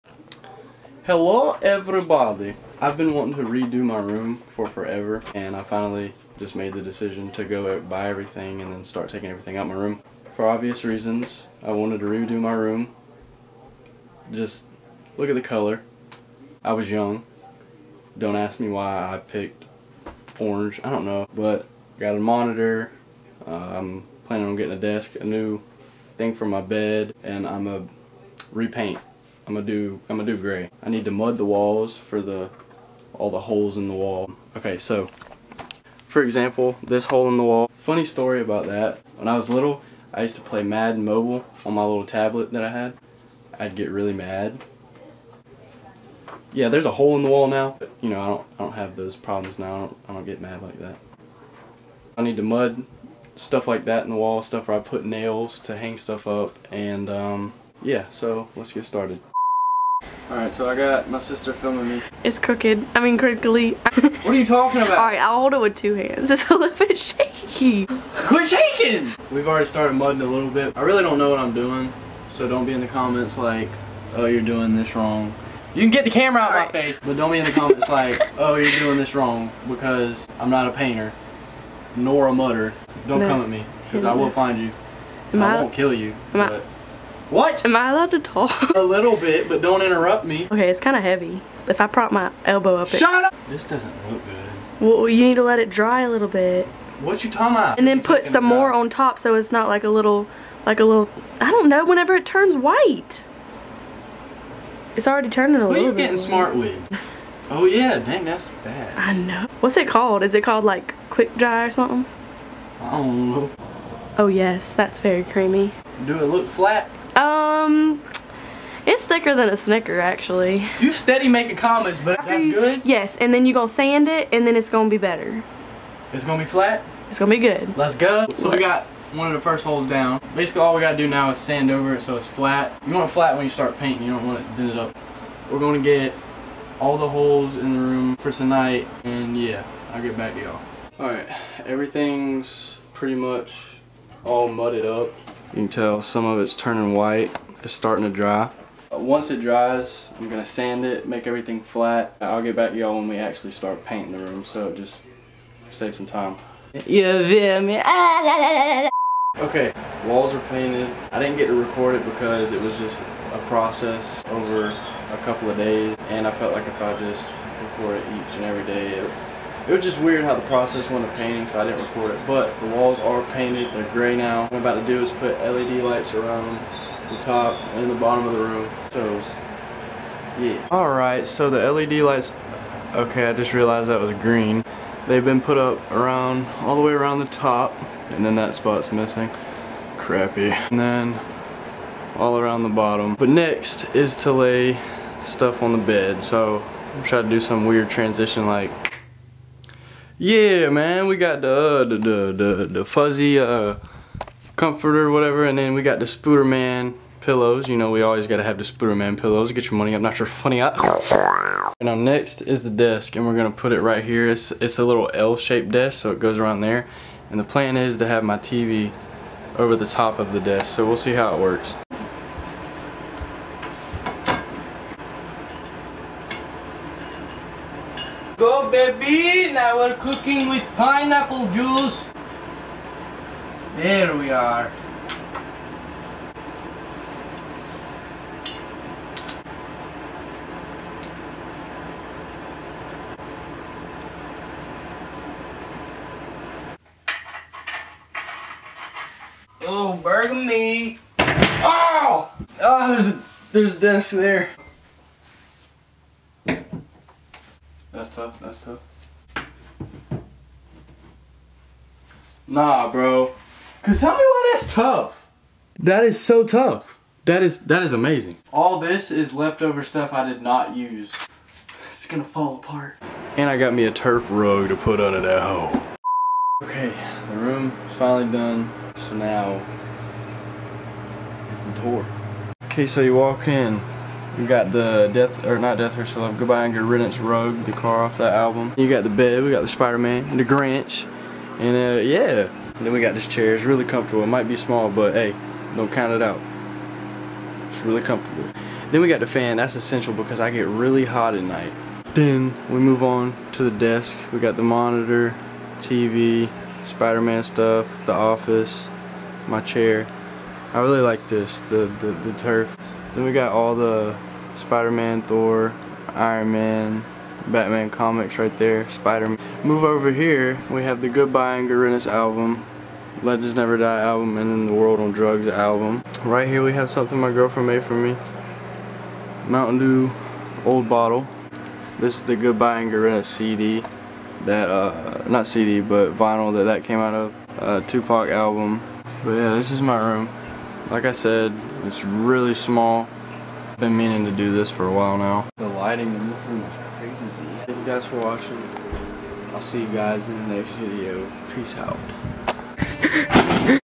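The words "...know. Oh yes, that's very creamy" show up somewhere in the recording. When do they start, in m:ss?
1:53.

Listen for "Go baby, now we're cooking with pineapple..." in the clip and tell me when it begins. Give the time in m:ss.
3:48.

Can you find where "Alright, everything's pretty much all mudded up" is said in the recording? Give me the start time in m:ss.
2:20.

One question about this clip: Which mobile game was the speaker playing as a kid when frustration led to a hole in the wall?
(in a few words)
Madden Mobile.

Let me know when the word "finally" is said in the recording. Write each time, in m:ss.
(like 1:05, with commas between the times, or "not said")
0:05, 4:37.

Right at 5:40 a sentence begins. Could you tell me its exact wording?
Like I said, it's really small.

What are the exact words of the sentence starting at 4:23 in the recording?
Cause tell me why that's tough.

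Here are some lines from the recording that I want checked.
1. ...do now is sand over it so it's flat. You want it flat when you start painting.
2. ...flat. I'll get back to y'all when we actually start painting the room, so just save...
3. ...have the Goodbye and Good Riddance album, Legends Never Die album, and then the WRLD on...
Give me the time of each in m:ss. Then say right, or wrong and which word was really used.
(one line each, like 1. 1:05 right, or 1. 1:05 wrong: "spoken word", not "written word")
1. 2:10 right
2. 2:31 right
3. 5:20 right.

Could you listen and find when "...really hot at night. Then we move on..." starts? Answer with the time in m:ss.
5:00.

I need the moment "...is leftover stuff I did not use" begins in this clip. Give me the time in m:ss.
4:29.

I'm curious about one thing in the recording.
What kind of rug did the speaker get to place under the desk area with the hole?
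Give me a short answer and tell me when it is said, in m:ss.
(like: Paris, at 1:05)
Turf rug, at 4:33.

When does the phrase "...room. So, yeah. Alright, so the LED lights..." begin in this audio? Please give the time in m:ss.
2:58.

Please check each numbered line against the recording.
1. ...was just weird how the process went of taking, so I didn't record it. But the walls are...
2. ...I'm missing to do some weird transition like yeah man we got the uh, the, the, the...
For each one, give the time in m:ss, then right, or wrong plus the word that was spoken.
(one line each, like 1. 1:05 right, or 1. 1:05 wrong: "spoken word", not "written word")
1. 2:49 wrong: "painting", not "taking"
2. 3:16 wrong: "trying", not "missing".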